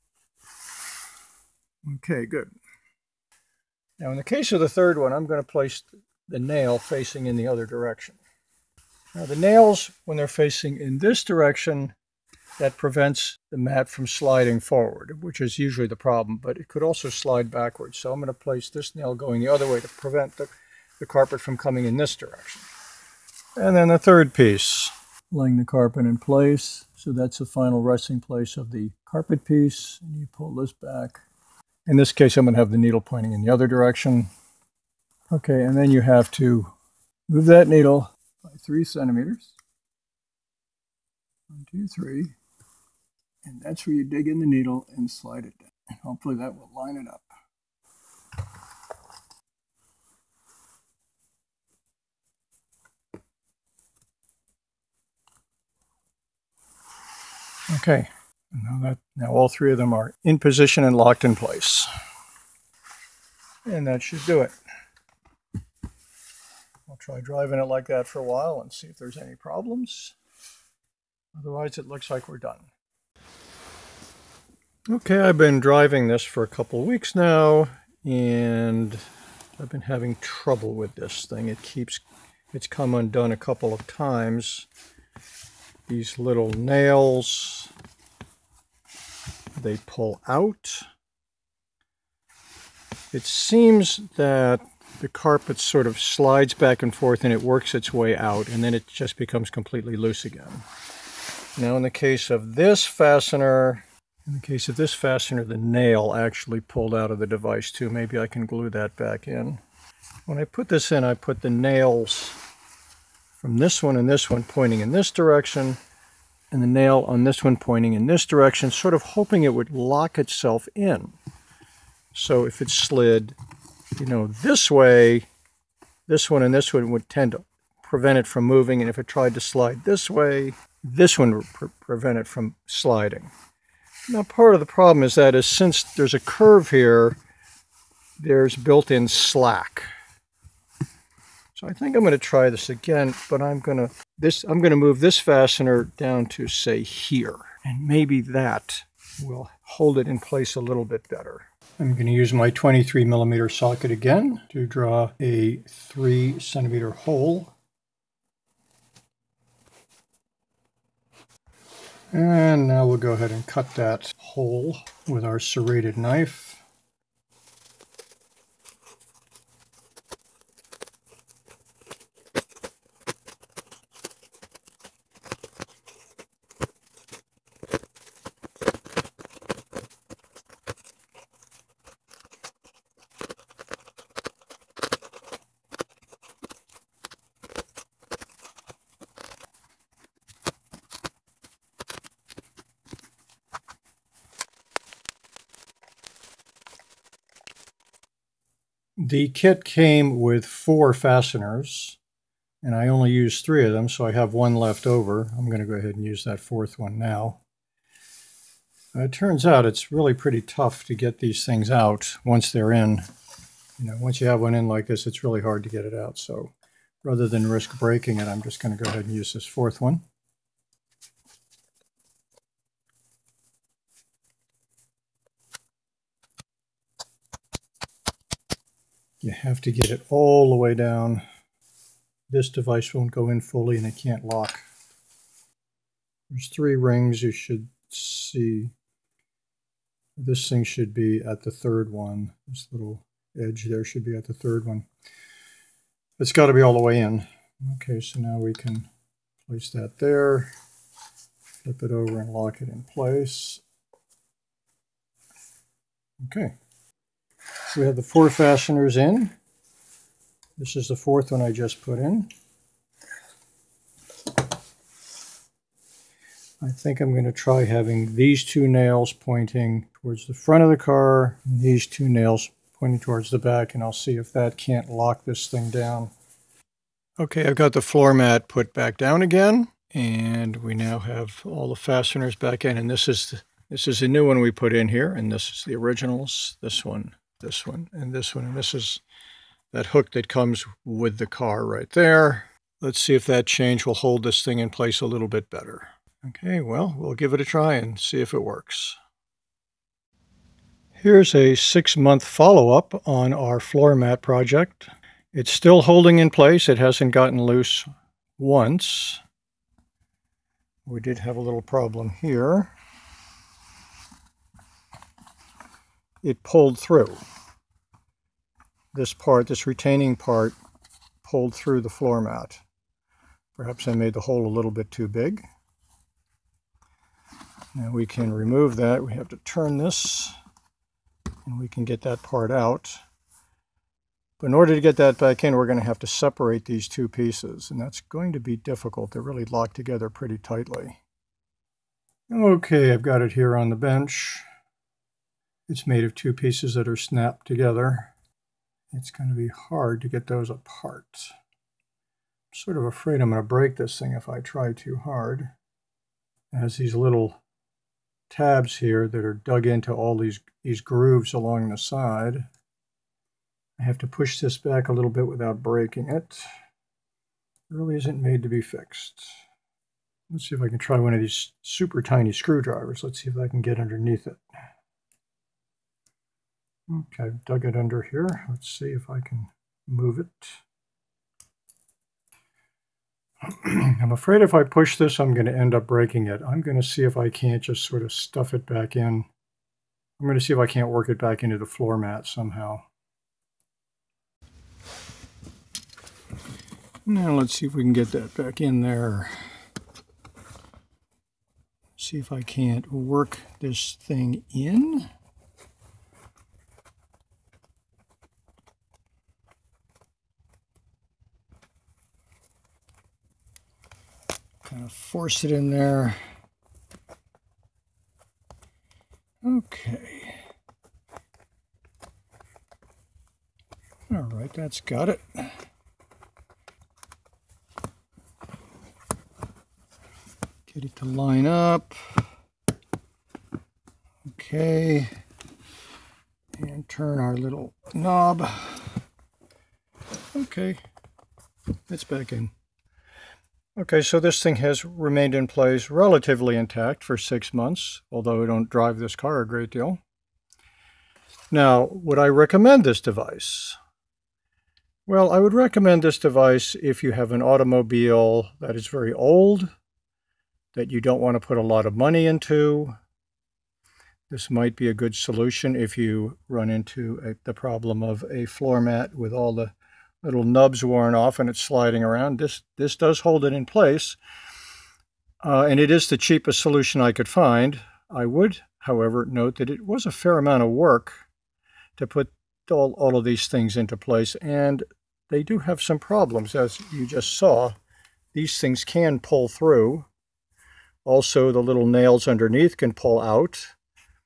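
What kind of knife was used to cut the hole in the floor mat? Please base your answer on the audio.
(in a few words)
serrated knife.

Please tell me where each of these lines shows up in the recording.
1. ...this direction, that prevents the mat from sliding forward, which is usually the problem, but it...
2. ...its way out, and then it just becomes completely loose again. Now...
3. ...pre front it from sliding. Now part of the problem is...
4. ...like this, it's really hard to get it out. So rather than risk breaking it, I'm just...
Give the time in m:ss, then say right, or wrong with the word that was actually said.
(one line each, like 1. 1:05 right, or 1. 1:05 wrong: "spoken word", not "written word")
1. 0:10 right
2. 1:37 right
3. 2:11 wrong: "prevent", not "front"
4. 3:34 right.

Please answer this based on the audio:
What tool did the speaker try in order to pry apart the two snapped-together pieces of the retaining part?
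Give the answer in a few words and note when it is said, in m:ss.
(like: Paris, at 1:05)
super tiny screwdrivers, at 6:11.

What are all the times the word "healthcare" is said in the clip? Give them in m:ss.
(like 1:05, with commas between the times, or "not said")
not said.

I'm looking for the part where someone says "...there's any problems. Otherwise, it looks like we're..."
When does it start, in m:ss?
1:08.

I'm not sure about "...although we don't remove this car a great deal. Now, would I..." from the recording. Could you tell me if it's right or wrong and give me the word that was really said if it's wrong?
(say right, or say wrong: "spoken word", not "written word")
wrong: "drive", not "remove".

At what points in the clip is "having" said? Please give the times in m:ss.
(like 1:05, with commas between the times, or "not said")
1:19, 4:27.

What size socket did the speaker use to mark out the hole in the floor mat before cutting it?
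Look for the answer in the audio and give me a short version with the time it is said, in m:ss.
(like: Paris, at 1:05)
23 millimeter, at 2:32.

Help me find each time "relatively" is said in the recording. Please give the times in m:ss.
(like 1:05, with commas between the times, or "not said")
7:25.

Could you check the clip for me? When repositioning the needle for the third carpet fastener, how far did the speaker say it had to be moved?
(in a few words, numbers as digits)
3 centimeters.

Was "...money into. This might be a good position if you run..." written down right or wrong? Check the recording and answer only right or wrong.
wrong.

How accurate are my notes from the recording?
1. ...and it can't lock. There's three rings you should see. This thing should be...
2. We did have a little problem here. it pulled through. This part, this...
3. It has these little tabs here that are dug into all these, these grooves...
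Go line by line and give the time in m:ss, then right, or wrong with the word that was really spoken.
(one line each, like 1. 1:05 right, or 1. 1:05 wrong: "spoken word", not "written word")
1. 3:53 right
2. 5:10 right
3. 5:56 right.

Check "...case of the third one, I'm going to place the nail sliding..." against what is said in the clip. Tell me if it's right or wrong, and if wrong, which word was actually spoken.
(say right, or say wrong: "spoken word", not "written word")
wrong: "facing", not "sliding".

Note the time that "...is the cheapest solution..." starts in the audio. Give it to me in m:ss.
7:55.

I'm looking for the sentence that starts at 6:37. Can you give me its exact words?
Now let's see if we can get that back in there.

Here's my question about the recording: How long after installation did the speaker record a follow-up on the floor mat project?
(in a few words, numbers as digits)
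6 months.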